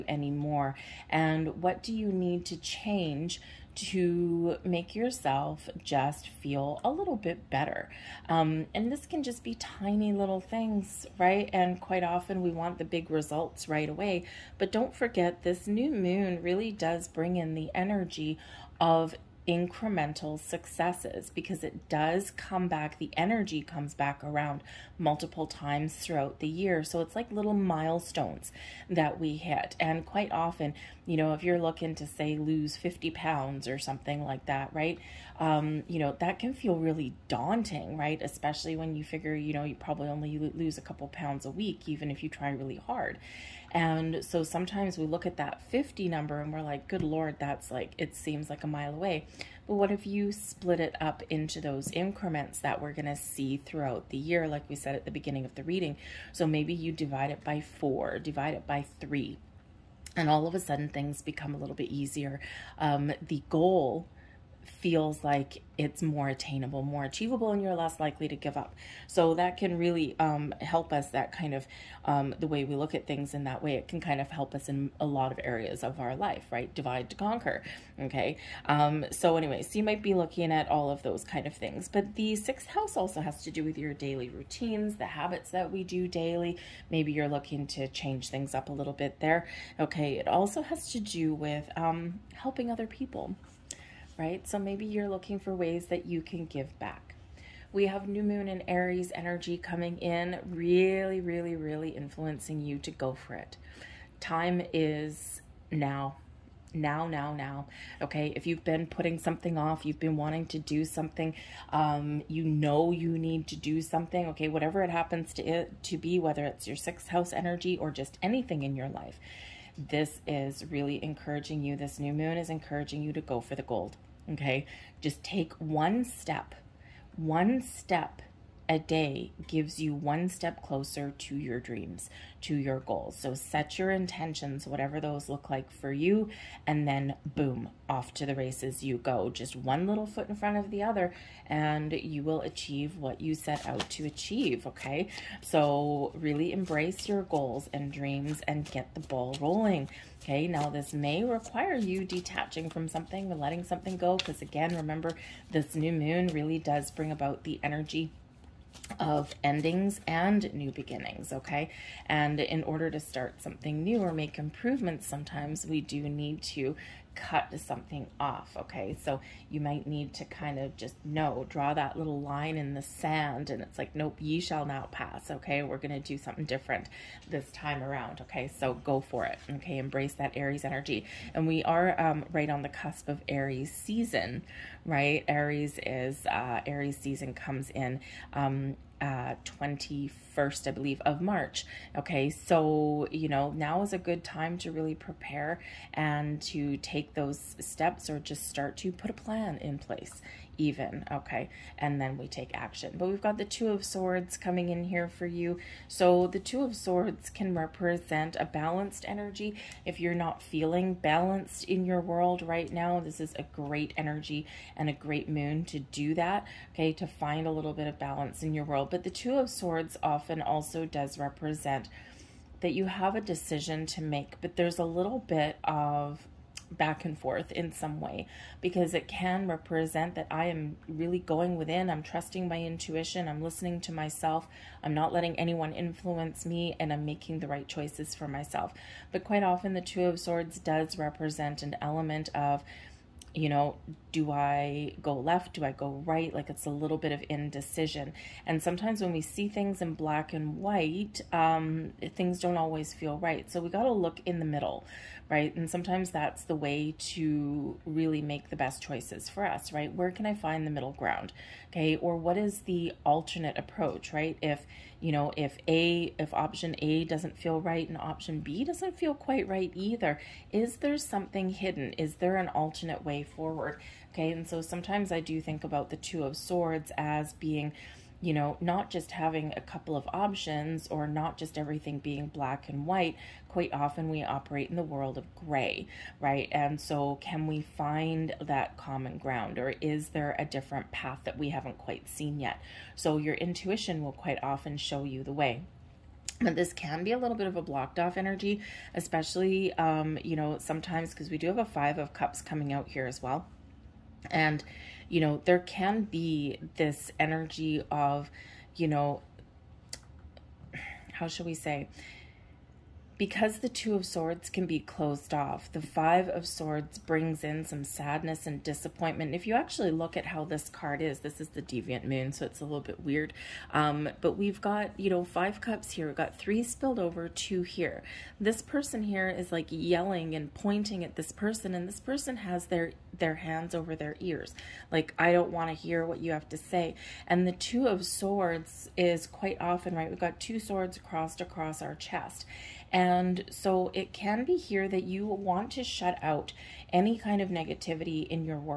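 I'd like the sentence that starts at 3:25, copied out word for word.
So the Two of Swords can represent a balanced energy.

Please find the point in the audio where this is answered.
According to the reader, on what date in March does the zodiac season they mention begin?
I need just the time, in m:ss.
3:09.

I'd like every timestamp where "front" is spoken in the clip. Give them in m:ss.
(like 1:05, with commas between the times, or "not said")
2:20.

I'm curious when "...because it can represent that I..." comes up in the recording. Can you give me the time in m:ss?
3:48.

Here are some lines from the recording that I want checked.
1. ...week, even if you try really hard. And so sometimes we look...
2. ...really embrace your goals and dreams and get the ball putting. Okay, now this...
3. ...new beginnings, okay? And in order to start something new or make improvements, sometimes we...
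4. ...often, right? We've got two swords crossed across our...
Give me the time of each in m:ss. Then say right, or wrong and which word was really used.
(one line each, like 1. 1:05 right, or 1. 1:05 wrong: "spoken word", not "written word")
1. 0:41 right
2. 2:26 wrong: "rolling", not "putting"
3. 2:40 right
4. 5:39 right.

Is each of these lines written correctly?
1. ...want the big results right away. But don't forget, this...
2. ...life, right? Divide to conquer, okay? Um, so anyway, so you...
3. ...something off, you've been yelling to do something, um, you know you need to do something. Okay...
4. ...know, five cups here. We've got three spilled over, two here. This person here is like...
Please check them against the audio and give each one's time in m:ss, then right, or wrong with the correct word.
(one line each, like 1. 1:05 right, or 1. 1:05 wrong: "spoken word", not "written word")
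1. 0:12 right
2. 1:16 right
3. 1:49 wrong: "wanting", not "yelling"
4. 5:25 right.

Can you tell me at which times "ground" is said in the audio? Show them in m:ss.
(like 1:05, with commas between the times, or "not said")
4:20, 4:49.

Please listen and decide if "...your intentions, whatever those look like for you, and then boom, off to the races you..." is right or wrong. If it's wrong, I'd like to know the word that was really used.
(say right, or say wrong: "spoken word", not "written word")
right.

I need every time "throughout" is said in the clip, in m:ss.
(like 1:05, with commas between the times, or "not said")
0:25, 0:53.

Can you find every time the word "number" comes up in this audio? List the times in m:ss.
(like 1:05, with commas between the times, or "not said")
0:46.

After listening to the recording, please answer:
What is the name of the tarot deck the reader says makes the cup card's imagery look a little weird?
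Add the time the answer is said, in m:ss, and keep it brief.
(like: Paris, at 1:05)
Deviant Moon, at 5:21.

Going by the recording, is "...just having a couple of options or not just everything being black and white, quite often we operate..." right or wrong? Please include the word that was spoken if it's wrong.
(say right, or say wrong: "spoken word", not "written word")
right.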